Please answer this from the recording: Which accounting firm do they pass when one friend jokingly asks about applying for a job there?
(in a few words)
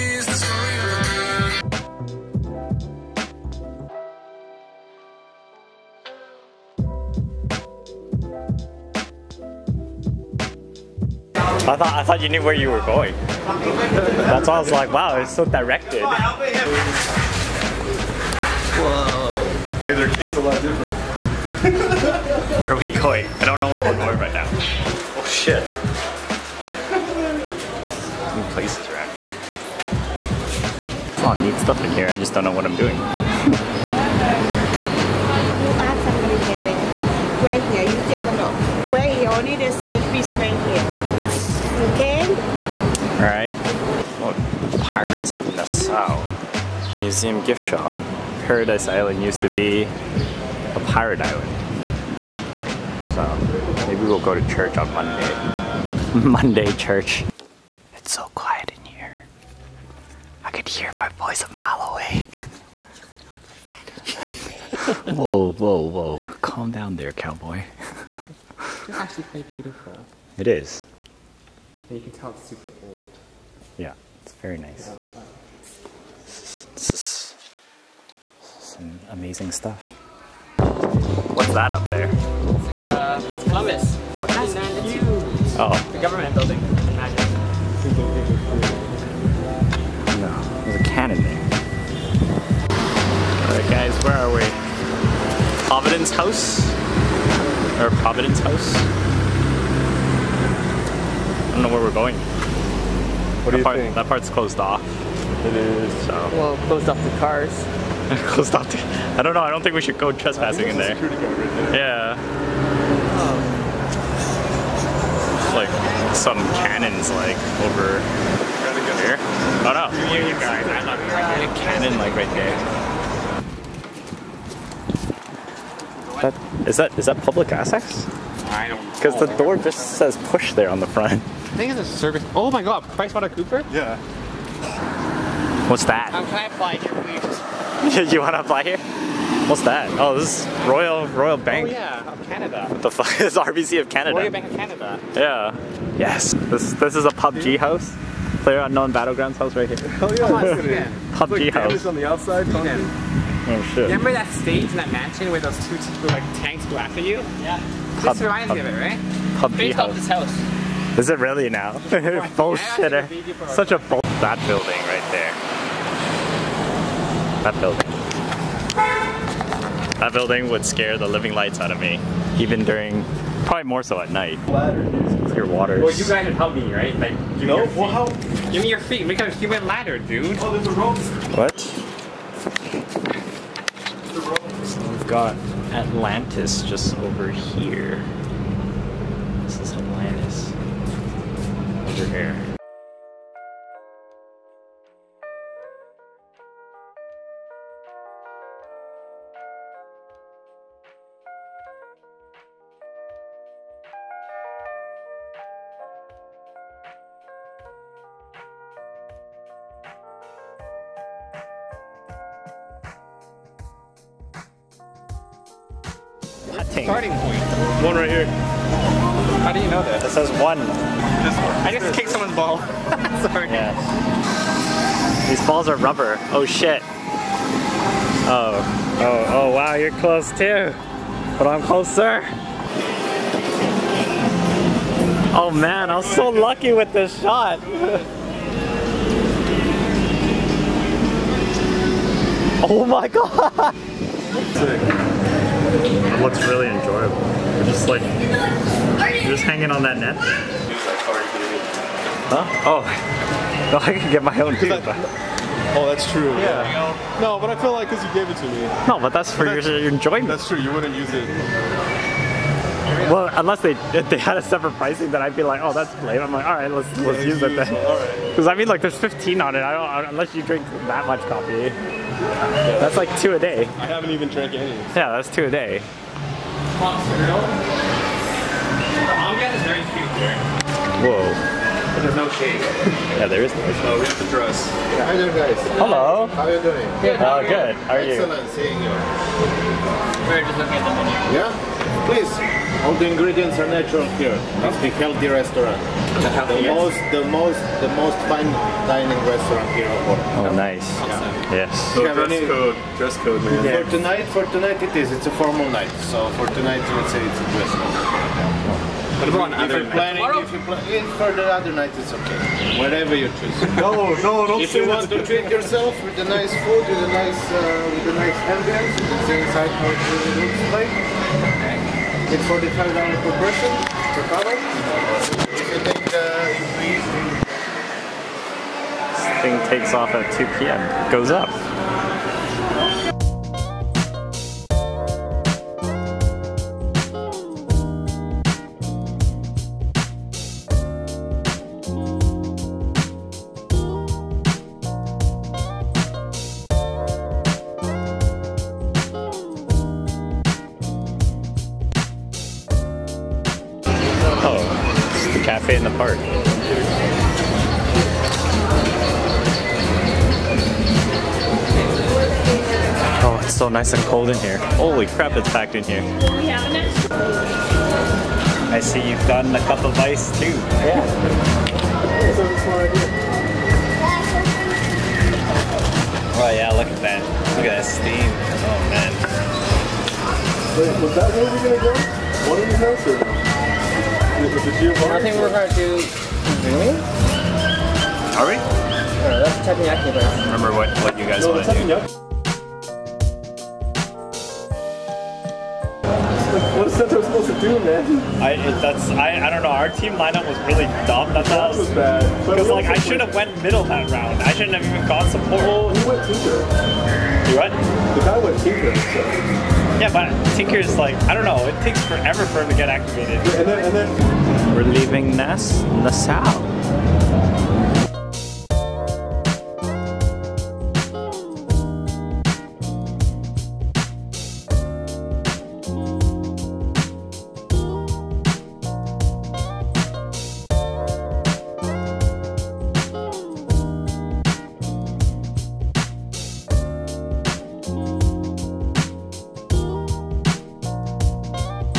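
Price Water Cooper.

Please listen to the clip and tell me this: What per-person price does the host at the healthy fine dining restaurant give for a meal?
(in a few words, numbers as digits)
$45.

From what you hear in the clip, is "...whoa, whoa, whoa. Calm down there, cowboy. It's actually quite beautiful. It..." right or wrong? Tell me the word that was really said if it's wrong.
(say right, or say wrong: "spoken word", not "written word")
right.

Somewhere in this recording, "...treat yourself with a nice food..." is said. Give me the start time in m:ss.
5:15.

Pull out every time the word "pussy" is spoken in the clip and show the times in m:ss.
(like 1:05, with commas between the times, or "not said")
not said.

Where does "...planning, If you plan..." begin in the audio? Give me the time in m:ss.
5:09.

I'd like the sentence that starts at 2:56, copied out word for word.
Like, no, Well, your Give me your feet.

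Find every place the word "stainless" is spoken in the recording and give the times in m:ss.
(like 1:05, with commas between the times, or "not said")
not said.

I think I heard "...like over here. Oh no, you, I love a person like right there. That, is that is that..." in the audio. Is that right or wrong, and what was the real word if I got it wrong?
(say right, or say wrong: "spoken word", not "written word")
wrong: "cannon", not "person".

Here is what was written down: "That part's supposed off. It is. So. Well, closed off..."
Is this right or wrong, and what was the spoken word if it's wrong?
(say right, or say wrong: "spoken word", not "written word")
wrong: "closed", not "supposed".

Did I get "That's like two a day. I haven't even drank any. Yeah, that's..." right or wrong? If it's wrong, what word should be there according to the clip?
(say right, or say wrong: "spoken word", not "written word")
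right.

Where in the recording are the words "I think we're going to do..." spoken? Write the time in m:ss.
6:24.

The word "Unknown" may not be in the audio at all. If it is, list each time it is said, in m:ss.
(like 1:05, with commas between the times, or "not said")
2:28.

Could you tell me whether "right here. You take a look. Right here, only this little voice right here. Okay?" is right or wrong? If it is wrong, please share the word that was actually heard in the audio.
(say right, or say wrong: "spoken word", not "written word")
wrong: "piece", not "voice".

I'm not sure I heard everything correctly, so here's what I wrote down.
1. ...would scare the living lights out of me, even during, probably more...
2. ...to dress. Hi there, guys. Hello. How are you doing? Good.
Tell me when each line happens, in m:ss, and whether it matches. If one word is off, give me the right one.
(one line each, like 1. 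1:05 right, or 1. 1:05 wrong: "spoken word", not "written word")
1. 2:50 right
2. 4:44 right.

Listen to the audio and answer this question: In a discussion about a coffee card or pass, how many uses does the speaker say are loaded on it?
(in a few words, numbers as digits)
15.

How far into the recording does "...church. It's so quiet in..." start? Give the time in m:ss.
0:56.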